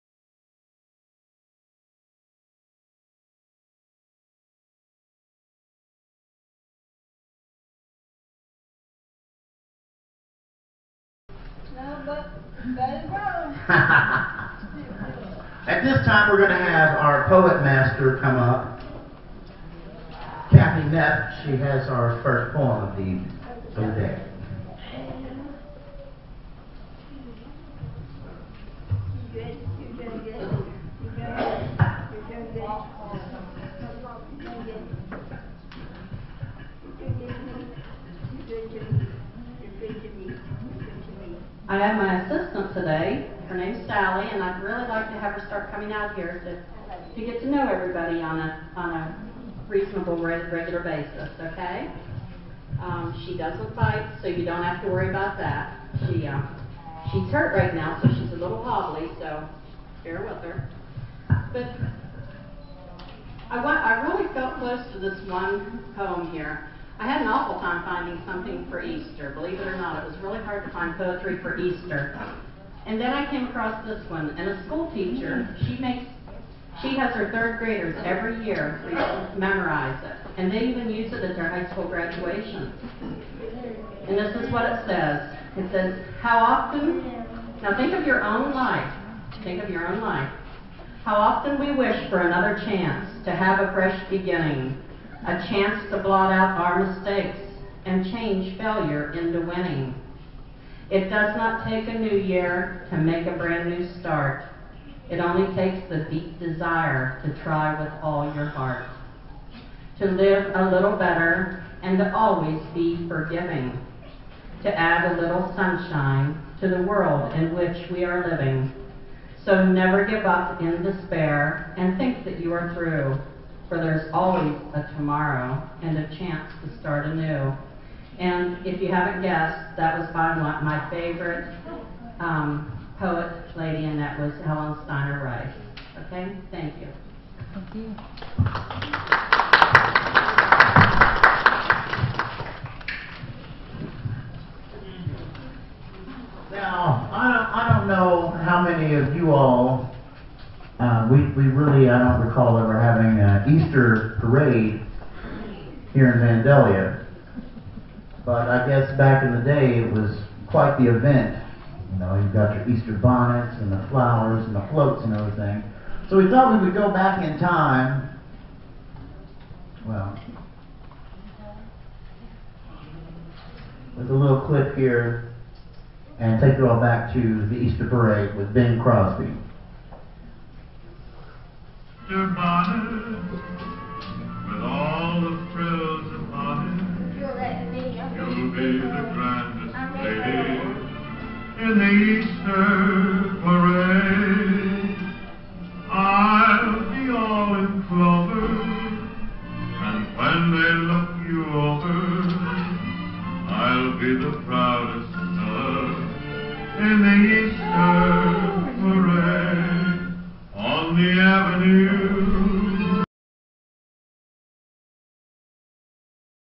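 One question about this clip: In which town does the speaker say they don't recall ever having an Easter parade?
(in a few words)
Vandalia.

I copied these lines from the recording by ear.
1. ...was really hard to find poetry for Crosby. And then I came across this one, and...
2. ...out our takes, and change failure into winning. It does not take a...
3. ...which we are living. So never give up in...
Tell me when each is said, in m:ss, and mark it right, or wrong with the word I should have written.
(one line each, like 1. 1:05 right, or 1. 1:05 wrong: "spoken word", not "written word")
1. 1:10 wrong: "Easter", not "Crosby"
2. 1:36 wrong: "mistakes", not "takes"
3. 1:57 right.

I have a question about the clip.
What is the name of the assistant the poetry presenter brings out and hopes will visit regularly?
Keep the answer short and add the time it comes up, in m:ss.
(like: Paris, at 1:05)
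Sally, at 0:43.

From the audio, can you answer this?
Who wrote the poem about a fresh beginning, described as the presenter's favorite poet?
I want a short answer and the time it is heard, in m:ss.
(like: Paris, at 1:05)
Helen Steiner Rice, at 2:14.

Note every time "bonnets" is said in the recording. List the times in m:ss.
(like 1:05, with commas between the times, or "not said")
2:42.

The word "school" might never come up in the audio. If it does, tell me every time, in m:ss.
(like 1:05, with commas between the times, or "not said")
1:14, 1:21.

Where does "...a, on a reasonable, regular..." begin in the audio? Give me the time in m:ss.
0:48.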